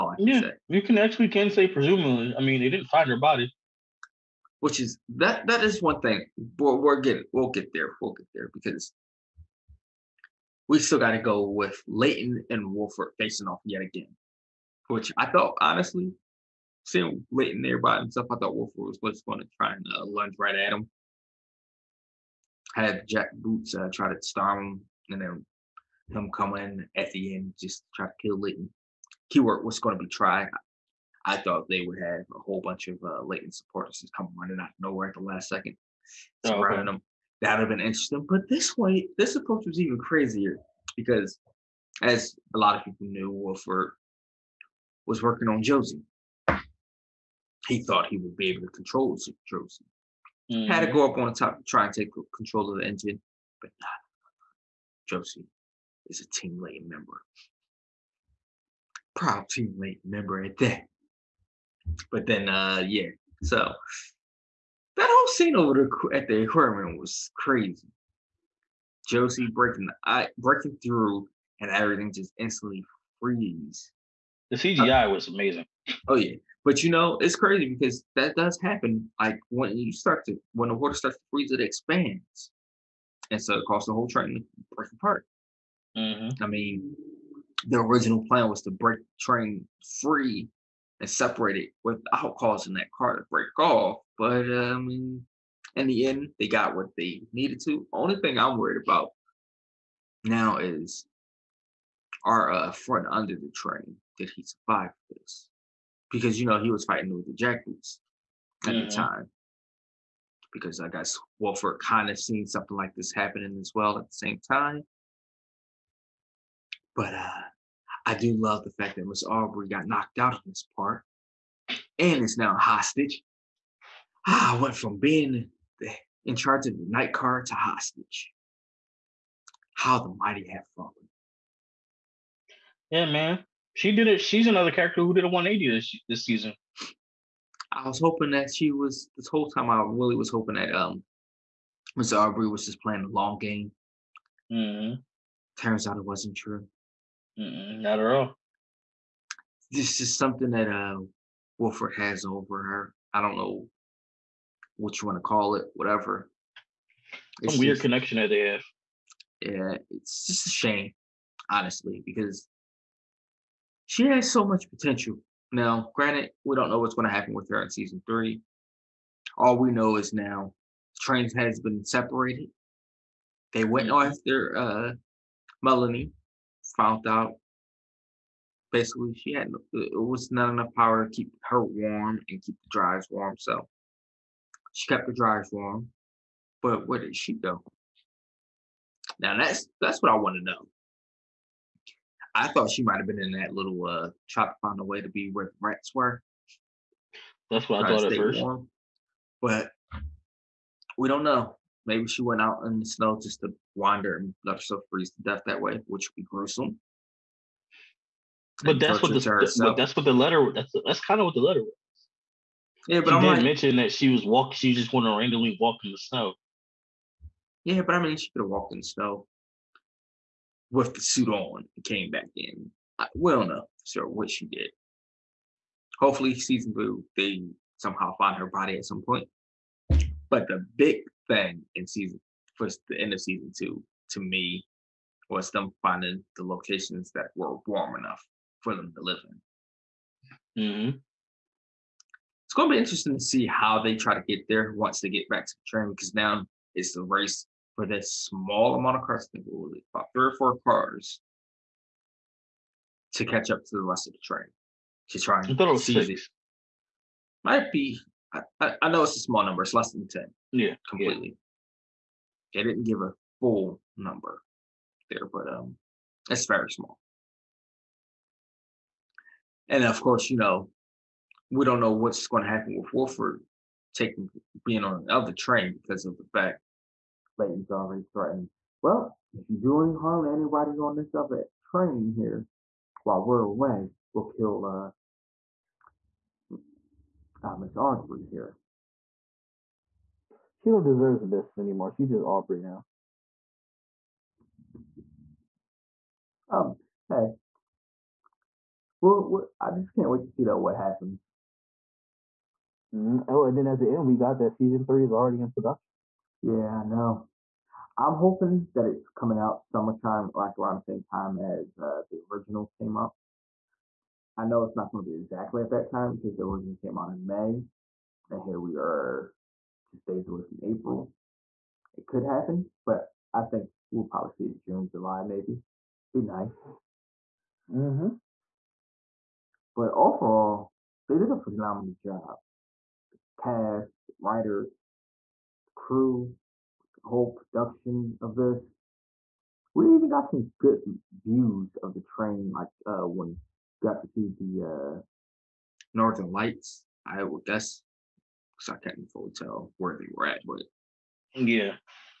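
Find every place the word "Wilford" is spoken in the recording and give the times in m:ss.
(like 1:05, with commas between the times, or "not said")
0:12, 0:18, 0:43, 1:51, 2:31, 4:32.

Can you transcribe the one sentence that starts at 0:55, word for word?
Josie is a team Layton member proud teammate member at that.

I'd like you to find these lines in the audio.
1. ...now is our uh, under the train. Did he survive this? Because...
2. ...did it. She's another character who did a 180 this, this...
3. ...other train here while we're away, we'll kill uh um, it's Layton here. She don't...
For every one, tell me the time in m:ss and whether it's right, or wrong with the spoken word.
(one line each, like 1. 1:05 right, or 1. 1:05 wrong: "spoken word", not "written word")
1. 1:40 right
2. 2:13 right
3. 4:41 wrong: "Audrey", not "Layton".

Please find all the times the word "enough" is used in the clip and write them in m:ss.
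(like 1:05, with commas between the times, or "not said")
3:00, 3:57.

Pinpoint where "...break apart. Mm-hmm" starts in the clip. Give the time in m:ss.
1:24.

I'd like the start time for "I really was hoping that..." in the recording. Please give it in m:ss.
2:19.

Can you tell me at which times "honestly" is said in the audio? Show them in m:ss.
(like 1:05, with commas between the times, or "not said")
0:15, 2:41.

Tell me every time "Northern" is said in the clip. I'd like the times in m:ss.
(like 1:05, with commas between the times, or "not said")
5:45.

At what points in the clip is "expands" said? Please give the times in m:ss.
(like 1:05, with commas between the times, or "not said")
1:21.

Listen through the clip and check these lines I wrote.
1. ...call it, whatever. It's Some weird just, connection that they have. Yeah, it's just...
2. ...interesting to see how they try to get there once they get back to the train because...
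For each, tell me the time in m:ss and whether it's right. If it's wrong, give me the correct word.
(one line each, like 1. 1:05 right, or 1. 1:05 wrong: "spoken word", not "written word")
1. 2:35 right
2. 4:02 right.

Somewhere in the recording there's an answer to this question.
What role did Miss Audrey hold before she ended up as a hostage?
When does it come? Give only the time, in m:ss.
2:06.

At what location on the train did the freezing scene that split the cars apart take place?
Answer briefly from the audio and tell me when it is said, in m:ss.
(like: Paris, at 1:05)
The aquarium, at 1:06.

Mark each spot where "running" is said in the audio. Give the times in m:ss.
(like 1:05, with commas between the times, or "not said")
0:34.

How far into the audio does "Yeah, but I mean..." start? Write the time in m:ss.
3:37.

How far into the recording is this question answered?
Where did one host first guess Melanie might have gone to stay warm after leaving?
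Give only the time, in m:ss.
3:15.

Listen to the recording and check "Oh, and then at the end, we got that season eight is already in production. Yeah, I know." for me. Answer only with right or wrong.
wrong.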